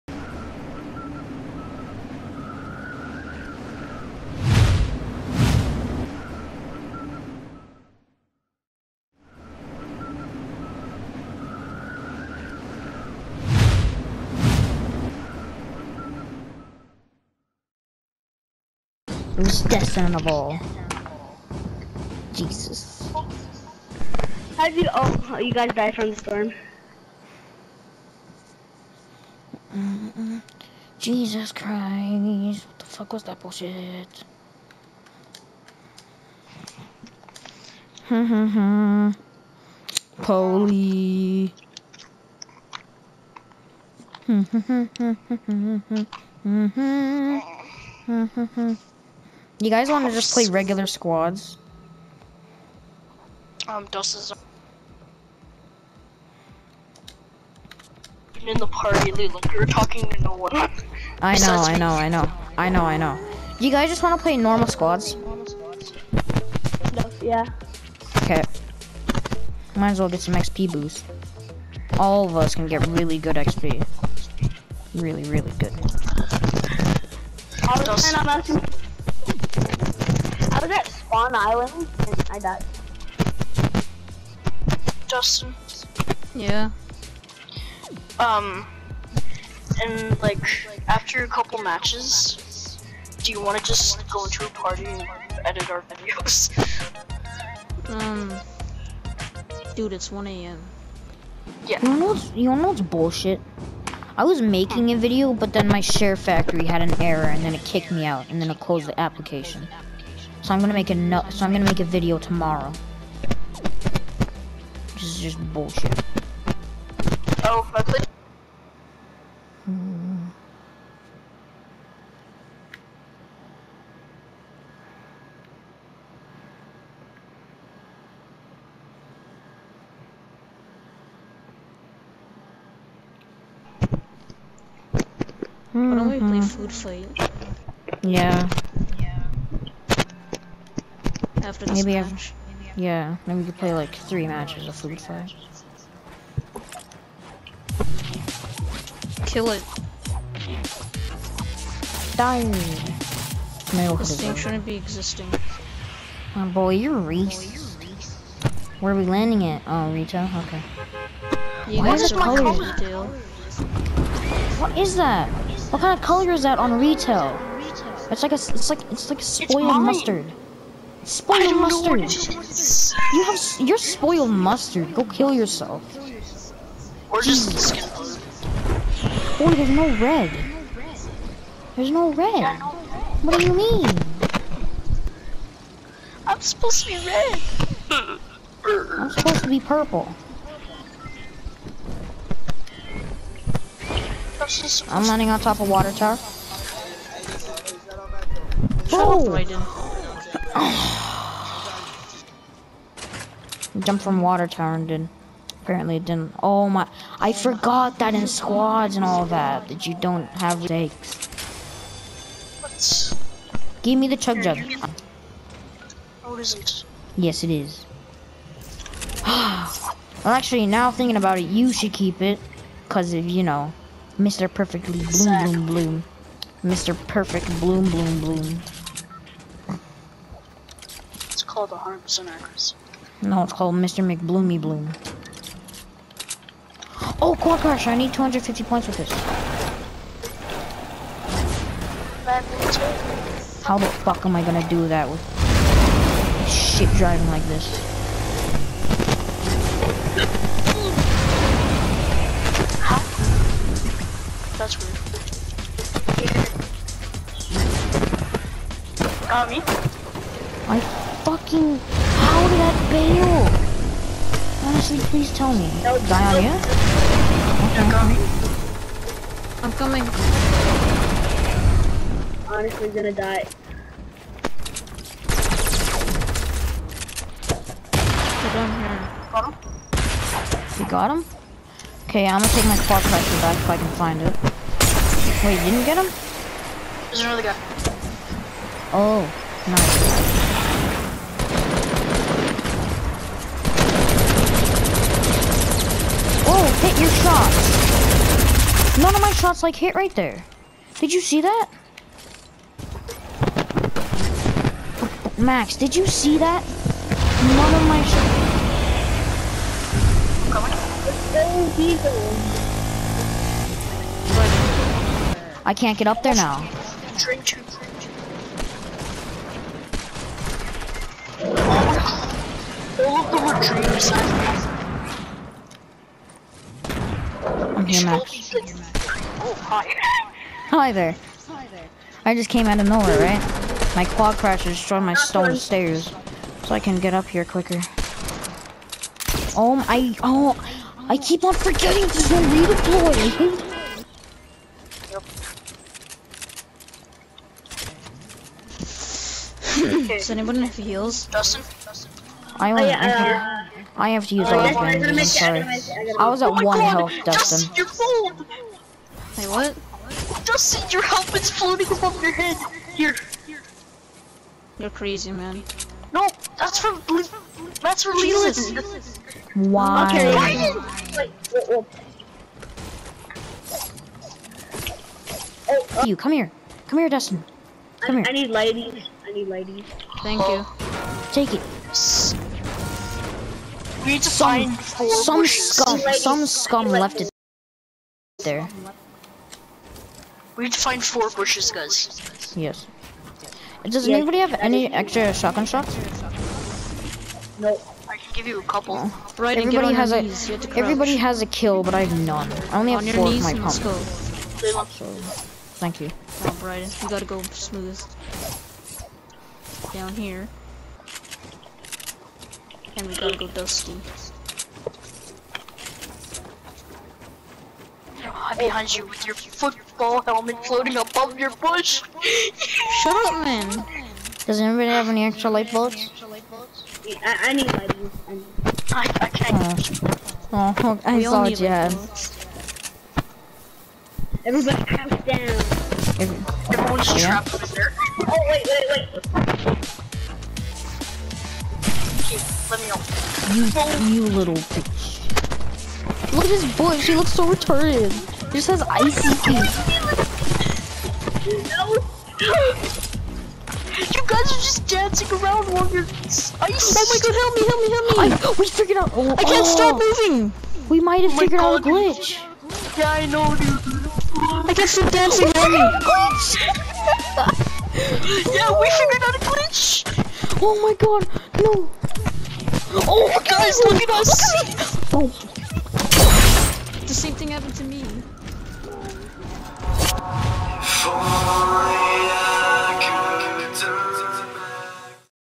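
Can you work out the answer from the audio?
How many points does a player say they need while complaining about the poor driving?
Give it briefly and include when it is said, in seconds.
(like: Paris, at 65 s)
250, at 238 s.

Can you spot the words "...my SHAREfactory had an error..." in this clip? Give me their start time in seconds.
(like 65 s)
105 s.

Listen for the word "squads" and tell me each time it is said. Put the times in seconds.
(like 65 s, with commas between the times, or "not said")
50 s, 64 s, 208 s.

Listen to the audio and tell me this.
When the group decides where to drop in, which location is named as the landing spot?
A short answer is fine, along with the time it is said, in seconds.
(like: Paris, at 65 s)
Rito, at 159 s.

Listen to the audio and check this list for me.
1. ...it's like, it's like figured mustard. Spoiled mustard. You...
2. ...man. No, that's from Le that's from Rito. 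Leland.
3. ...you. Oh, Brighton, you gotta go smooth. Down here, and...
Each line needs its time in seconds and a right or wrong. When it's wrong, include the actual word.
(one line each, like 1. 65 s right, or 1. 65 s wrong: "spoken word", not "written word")
1. 168 s wrong: "spoiled", not "figured"
2. 365 s wrong: "Jesus", not "Rito"
3. 405 s right.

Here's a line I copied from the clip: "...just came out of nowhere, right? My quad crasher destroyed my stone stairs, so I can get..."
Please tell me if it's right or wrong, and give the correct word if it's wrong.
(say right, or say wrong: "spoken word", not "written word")
right.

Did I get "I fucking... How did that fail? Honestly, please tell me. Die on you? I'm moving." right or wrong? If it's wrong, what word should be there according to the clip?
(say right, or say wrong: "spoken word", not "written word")
wrong: "coming", not "moving".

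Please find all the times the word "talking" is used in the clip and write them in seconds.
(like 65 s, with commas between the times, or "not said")
59 s.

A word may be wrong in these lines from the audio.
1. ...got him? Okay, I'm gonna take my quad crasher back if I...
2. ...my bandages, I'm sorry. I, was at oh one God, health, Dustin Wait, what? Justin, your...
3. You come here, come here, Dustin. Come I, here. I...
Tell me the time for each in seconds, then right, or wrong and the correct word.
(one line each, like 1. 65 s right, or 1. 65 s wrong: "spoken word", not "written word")
1. 280 s right
2. 354 s right
3. 376 s right.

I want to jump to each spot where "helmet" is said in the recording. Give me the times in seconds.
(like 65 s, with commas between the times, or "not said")
361 s, 420 s.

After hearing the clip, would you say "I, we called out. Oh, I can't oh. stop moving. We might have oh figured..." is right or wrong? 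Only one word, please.
wrong.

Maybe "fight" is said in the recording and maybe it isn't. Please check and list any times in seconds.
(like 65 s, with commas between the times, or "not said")
136 s, 145 s.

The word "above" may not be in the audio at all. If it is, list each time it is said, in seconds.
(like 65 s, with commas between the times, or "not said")
361 s, 420 s.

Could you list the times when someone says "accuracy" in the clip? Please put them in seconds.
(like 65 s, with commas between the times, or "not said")
232 s.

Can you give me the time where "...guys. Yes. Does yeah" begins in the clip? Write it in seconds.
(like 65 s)
391 s.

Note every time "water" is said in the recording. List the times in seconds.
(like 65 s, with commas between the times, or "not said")
195 s, 204 s.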